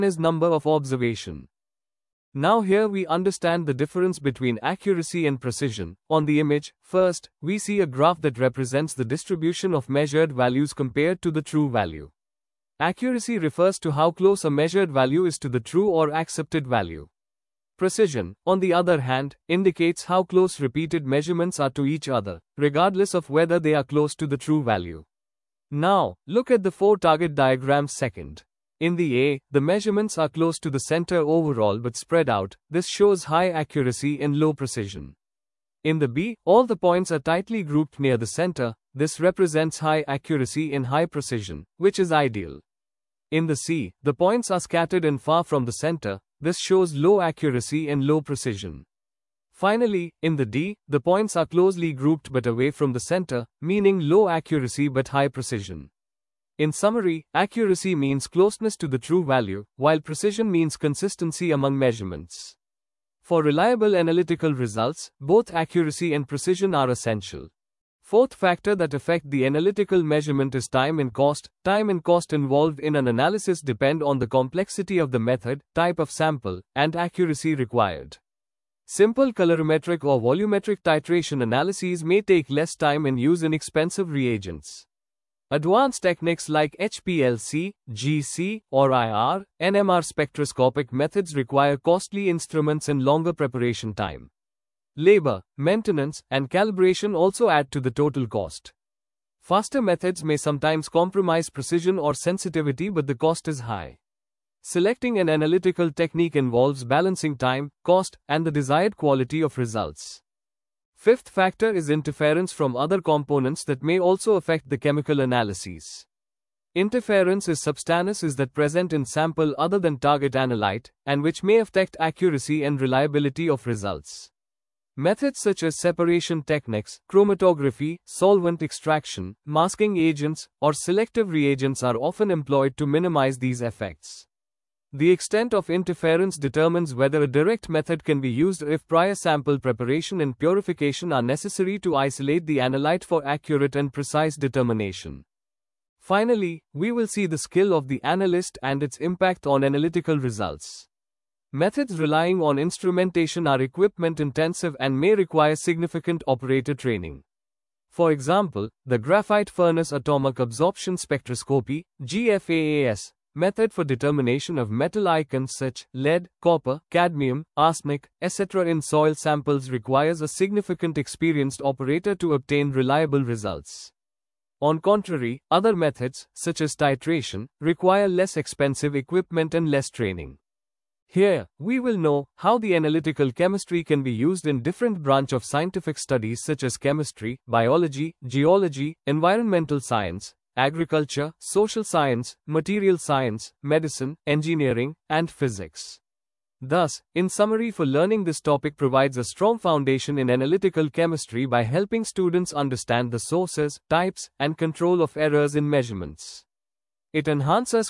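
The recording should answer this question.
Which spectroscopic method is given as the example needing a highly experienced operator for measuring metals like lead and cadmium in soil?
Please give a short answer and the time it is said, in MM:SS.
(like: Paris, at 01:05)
GFAAS, at 02:41.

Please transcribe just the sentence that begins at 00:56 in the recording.
In summary, accuracy means closeness to the true value, while precision means consistency among measurements.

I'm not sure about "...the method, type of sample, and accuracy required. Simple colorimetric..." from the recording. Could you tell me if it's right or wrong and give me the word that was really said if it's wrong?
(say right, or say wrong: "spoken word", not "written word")
right.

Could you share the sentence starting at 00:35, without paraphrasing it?
In the B, all the points are tightly grouped near the center, this represents high accuracy and high precision, which is ideal.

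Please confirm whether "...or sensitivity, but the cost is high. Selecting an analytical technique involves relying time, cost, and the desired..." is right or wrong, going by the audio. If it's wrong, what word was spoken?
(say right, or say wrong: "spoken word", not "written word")
wrong: "balancing", not "relying".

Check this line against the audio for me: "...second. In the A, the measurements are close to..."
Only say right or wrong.
right.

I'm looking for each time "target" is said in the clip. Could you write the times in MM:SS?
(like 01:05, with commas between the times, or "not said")
00:26, 01:59.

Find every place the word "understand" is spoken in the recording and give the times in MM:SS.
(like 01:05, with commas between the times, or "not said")
00:03, 03:22.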